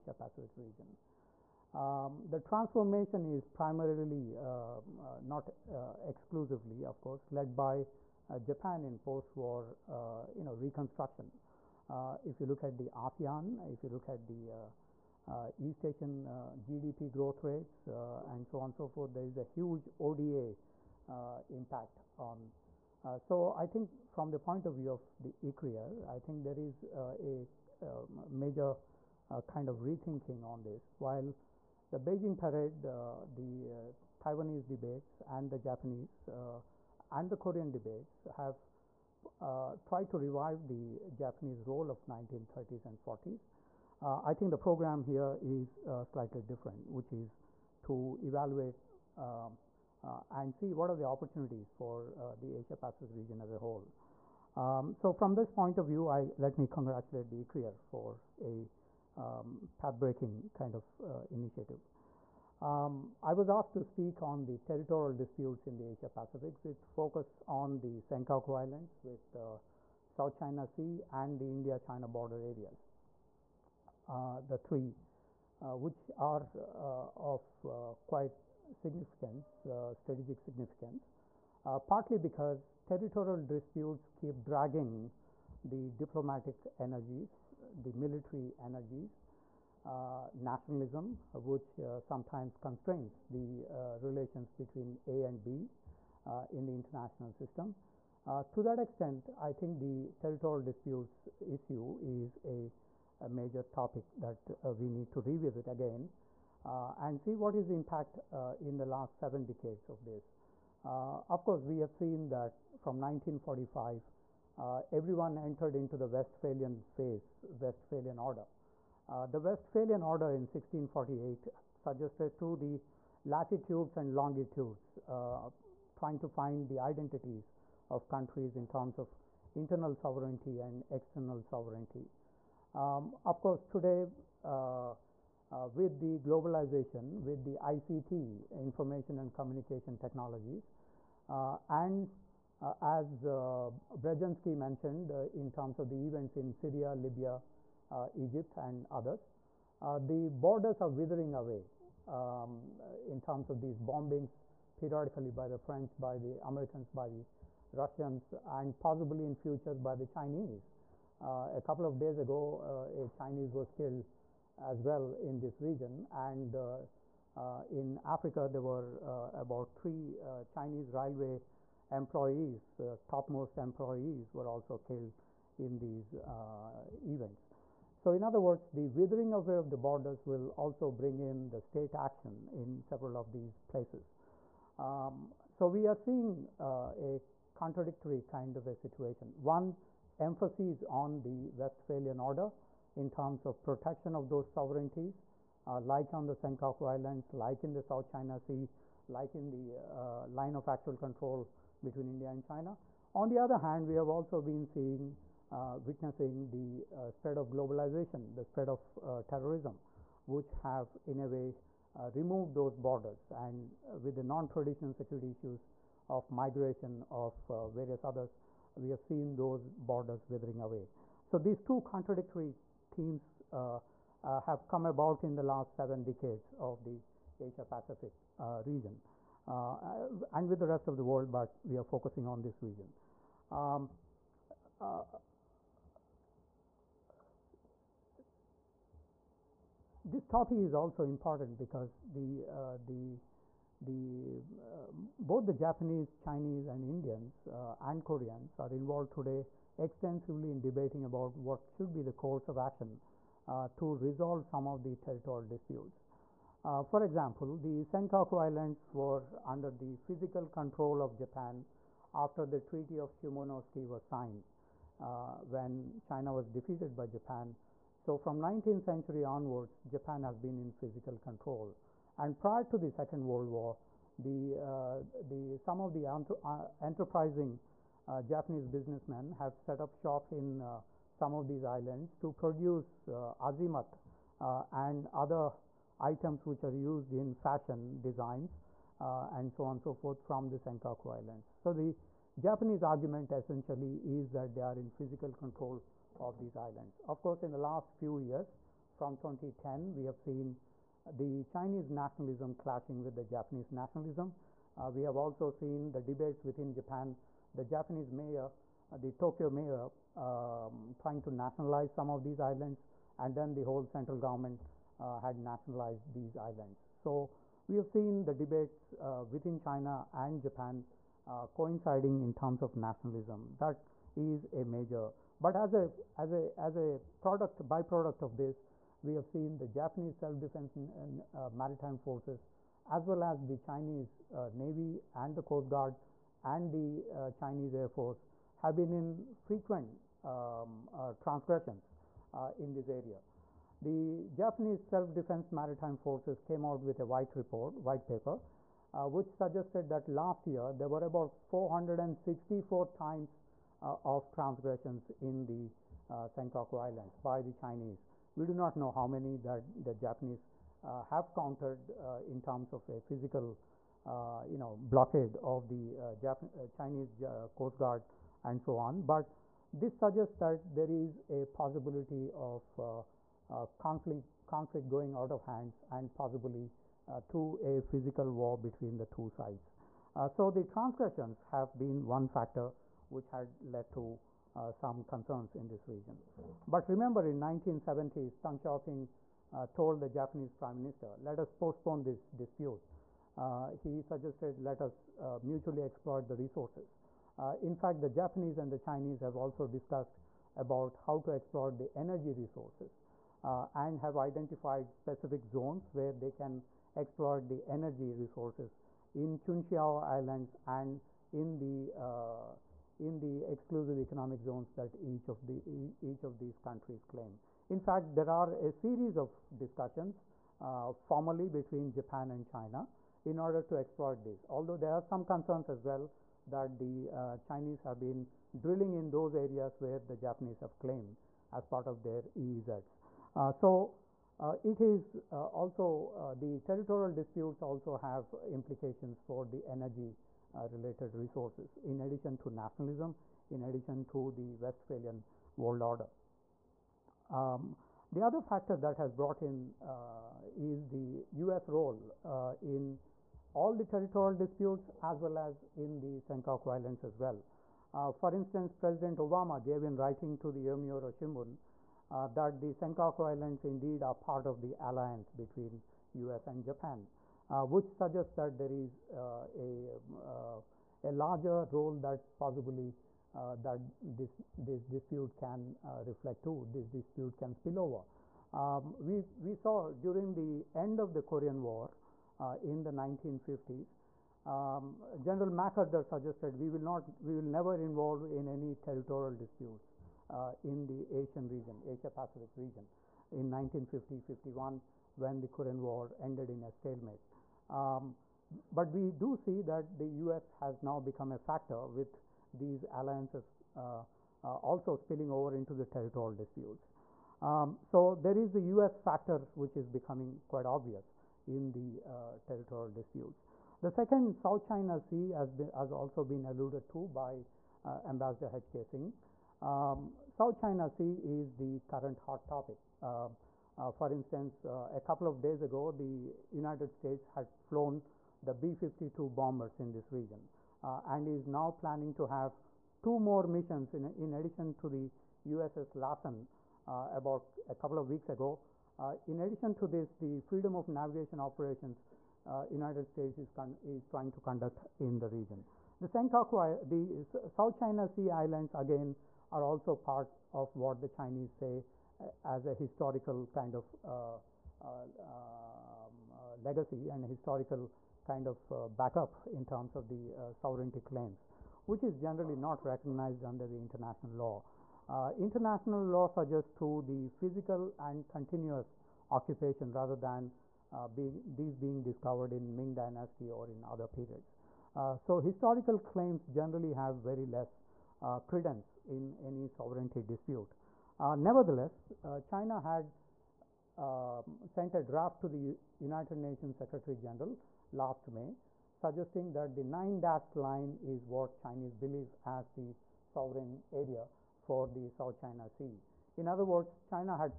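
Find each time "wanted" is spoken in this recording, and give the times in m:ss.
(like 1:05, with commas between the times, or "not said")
not said.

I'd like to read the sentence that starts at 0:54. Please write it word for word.
Um, so from this point of view, I, let me congratulate the ICRIER for a um, path-breaking kind of uh, initiative.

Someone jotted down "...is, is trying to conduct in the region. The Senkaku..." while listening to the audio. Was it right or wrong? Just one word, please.
right.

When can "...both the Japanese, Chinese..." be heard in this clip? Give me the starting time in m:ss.
4:05.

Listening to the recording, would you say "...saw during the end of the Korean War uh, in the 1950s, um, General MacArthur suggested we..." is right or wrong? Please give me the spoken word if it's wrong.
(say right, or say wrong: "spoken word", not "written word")
right.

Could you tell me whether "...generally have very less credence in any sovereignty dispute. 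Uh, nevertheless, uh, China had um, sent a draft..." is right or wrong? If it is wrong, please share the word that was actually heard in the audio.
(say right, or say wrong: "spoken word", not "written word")
right.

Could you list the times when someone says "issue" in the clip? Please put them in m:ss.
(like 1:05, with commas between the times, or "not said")
1:41, 3:35.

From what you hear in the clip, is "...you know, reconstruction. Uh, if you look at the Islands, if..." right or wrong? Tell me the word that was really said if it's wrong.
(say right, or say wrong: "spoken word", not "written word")
wrong: "ASEAN", not "Islands".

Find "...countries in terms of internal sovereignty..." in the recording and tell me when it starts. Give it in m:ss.
2:08.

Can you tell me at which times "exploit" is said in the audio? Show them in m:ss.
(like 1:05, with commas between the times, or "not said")
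6:35, 6:41, 6:46, 7:03.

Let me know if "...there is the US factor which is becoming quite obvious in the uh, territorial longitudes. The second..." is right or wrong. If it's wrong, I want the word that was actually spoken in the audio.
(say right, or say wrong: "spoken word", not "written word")
wrong: "disputes", not "longitudes".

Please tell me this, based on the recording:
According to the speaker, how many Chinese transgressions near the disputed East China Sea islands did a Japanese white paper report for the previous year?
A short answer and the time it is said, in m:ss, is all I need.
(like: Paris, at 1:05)
464, at 5:51.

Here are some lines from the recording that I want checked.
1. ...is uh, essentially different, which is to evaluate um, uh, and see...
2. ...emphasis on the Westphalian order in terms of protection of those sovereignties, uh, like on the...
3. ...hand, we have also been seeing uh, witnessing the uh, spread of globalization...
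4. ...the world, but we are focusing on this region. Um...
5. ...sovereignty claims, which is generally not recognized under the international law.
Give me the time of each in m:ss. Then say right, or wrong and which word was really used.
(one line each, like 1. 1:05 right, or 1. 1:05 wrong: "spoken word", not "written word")
1. 0:45 wrong: "slightly", not "essentially"
2. 3:10 right
3. 3:23 right
4. 3:50 right
5. 9:20 right.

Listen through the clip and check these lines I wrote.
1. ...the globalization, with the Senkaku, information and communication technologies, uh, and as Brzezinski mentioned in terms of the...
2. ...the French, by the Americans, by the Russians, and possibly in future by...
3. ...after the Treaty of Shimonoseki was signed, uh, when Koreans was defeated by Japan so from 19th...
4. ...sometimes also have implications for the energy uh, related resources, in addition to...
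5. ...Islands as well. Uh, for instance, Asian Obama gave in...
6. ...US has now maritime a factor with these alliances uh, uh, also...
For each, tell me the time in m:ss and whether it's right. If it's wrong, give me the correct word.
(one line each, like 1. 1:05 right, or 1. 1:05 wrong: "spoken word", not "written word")
1. 2:15 wrong: "ICT", not "Senkaku"
2. 2:35 right
3. 4:22 wrong: "China", not "Koreans"
4. 7:17 wrong: "disputes", not "sometimes"
5. 7:36 wrong: "President", not "Asian"
6. 8:20 wrong: "become", not "maritime".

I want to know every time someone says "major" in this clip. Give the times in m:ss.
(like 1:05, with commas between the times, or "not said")
0:28, 1:43, 5:24.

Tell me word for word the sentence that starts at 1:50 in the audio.
Uh, of course, we have seen that from 1945, uh, everyone entered into the Westphalian phase, Westphalian order.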